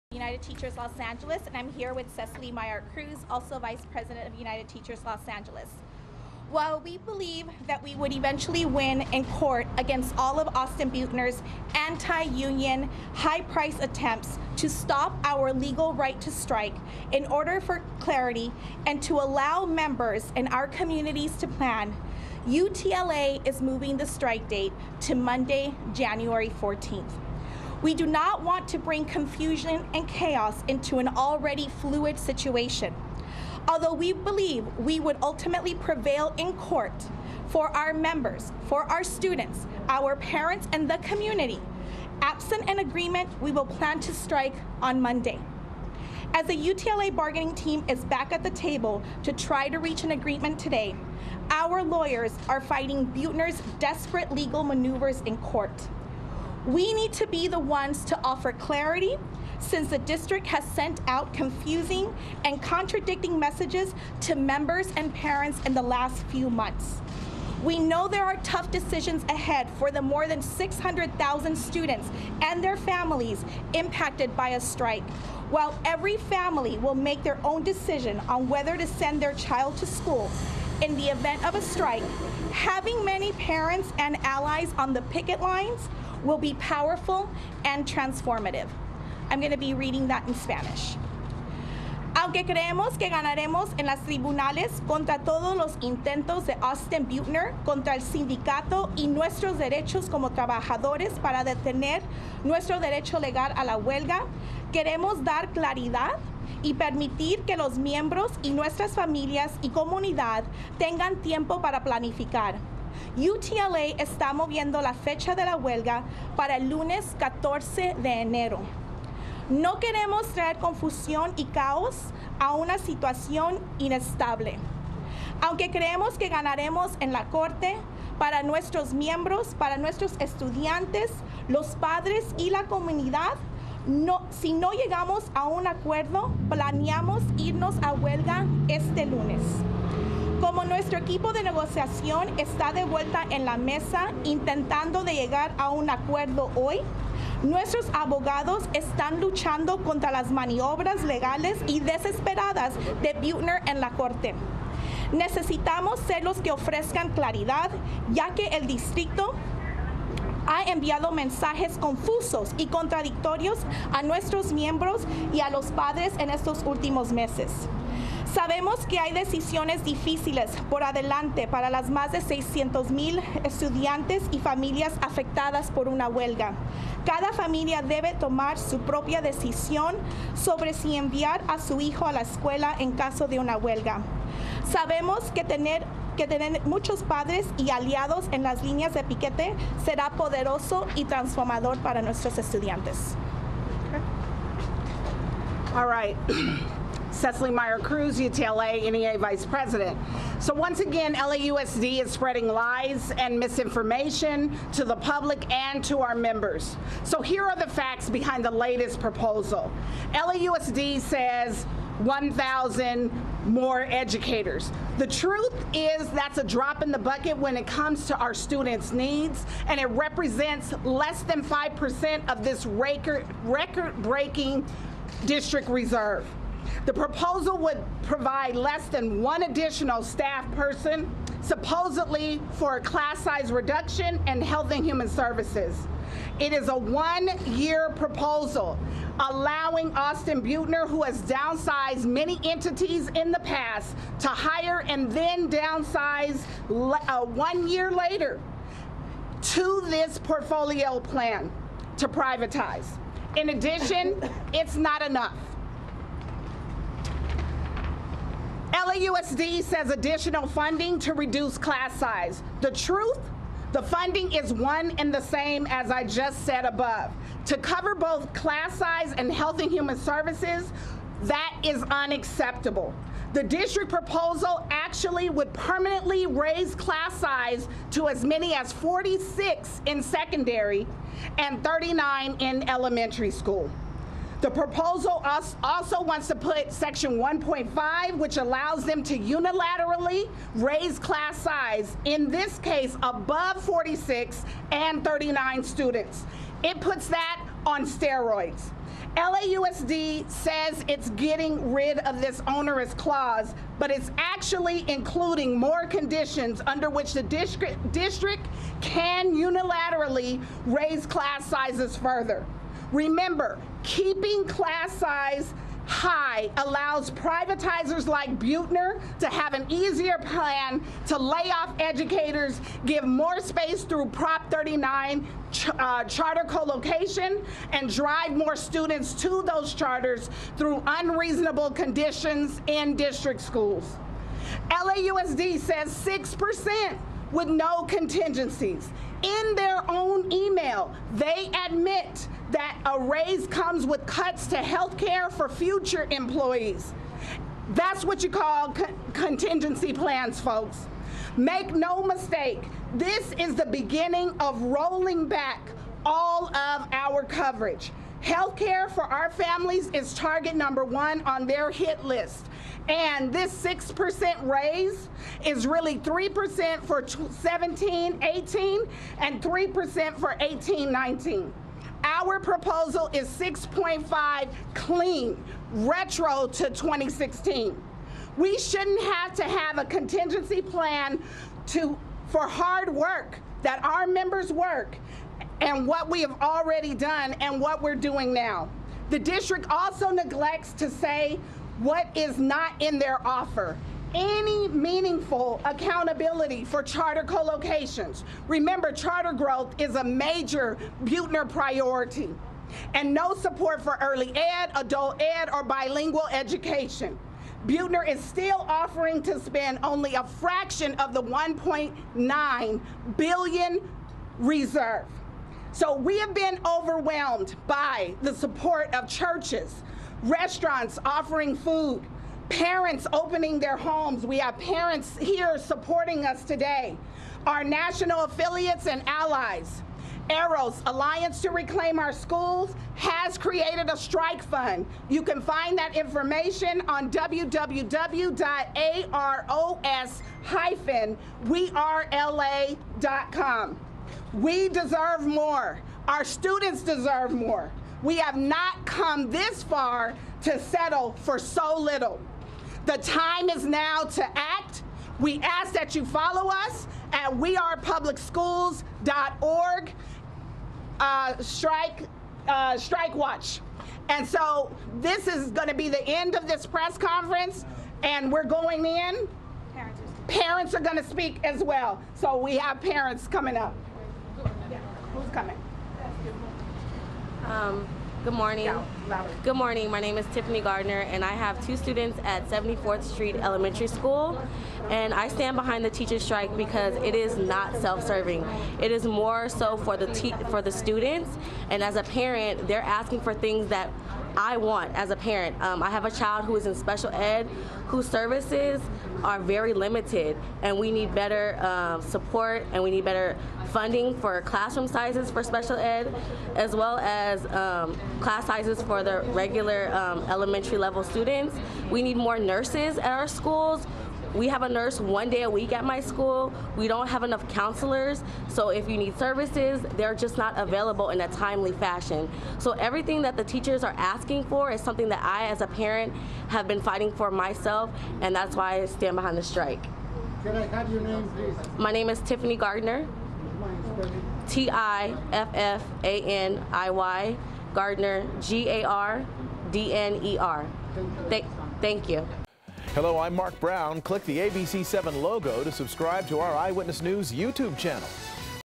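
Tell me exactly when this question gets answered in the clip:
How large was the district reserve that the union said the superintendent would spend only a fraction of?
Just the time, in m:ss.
6:51.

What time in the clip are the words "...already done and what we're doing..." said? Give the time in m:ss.
6:26.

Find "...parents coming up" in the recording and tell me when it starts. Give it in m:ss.
7:52.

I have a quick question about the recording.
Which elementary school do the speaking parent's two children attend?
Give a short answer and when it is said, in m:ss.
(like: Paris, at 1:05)
74th Street Elementary School, at 8:02.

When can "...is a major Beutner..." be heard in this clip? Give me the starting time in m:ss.
6:39.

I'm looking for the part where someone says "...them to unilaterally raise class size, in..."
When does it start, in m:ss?
4:48.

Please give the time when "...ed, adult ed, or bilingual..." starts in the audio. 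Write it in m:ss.
6:44.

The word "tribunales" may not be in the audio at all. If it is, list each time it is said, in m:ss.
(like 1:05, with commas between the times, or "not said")
1:34.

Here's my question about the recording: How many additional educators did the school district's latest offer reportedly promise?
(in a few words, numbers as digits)
1,000.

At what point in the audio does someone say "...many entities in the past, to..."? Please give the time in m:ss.
4:02.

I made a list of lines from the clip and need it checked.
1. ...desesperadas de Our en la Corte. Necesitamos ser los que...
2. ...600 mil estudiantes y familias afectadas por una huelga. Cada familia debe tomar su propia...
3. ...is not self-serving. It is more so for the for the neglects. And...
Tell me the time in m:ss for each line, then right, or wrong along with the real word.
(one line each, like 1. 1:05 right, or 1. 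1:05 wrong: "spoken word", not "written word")
1. 2:31 wrong: "Butner", not "Our"
2. 2:52 right
3. 8:07 wrong: "students", not "neglects".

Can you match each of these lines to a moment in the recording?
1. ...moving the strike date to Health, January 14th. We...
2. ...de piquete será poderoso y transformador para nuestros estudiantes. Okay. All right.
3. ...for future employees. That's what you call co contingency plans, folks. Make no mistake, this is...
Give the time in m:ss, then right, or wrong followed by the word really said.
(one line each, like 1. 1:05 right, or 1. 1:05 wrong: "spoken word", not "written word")
1. 0:23 wrong: "Monday", not "Health"
2. 3:08 right
3. 5:45 right.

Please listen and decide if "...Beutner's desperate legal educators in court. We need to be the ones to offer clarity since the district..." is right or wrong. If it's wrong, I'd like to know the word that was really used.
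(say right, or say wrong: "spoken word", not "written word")
wrong: "maneuvers", not "educators".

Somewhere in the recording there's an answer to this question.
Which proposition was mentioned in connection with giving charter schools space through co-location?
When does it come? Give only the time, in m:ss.
5:24.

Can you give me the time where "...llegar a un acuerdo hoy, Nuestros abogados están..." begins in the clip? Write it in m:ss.
2:25.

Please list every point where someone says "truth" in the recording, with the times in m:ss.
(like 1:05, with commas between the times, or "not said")
3:35, 4:22.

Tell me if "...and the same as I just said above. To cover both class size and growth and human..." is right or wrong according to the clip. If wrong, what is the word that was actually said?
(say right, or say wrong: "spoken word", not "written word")
wrong: "health", not "growth".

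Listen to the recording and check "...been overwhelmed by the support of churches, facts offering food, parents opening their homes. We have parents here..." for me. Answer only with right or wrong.
wrong.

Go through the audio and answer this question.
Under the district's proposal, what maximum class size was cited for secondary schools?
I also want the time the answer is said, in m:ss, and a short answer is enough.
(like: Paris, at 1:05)
46, at 4:38.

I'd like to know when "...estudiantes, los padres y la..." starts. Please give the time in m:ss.
2:10.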